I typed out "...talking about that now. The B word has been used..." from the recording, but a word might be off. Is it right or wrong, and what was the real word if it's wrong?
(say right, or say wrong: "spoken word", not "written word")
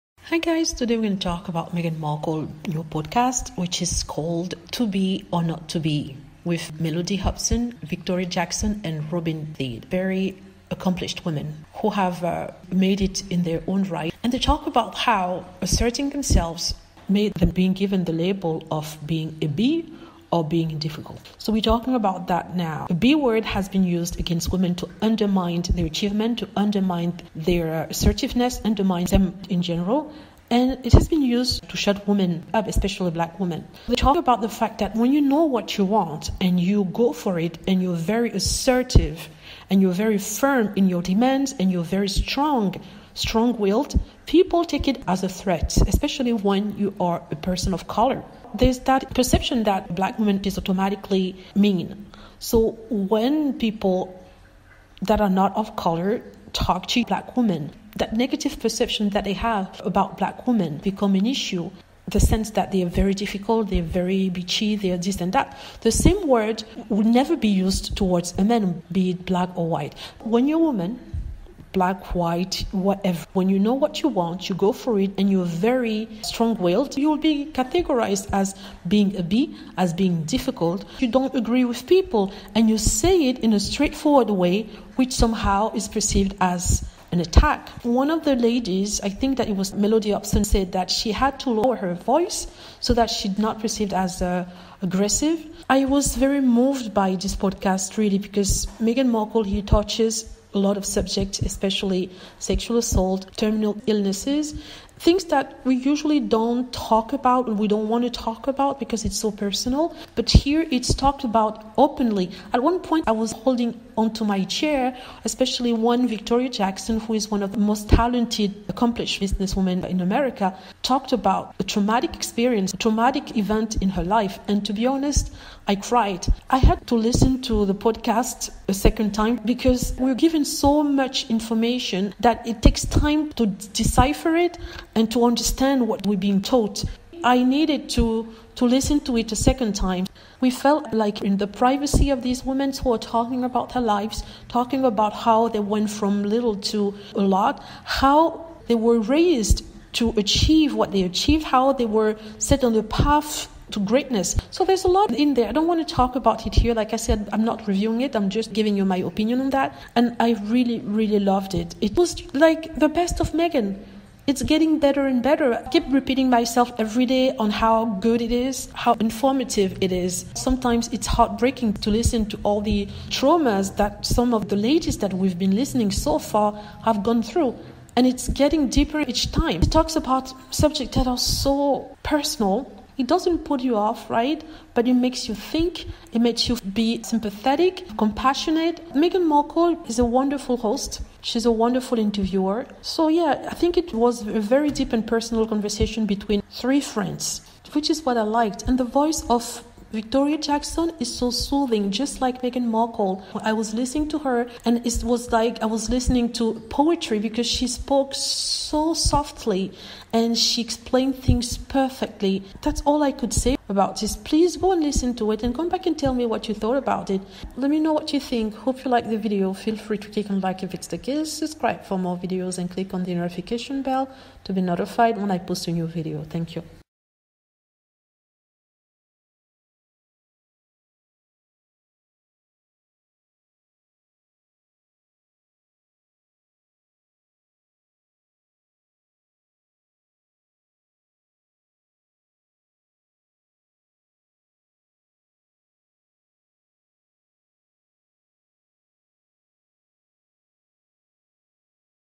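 right.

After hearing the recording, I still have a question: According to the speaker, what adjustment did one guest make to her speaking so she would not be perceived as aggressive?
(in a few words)
Lower her voice.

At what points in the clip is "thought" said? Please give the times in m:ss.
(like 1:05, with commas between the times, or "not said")
3:36.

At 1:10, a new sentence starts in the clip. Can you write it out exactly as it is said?
When you're a woman, black, white, whatever.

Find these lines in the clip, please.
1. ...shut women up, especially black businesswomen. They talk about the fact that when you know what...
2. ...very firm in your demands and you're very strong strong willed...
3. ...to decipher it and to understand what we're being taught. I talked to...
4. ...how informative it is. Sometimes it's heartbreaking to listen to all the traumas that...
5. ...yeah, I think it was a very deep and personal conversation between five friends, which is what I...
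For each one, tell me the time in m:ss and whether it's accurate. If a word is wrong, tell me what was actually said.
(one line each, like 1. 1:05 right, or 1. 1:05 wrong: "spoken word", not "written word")
1. 0:31 wrong: "women", not "businesswomen"
2. 0:39 right
3. 2:13 wrong: "needed", not "talked"
4. 2:48 right
5. 3:13 wrong: "three", not "five".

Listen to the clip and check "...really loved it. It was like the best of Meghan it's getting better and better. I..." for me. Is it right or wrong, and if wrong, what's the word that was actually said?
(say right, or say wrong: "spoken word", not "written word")
right.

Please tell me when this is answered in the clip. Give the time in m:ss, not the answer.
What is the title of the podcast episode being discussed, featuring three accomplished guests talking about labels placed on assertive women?
0:04.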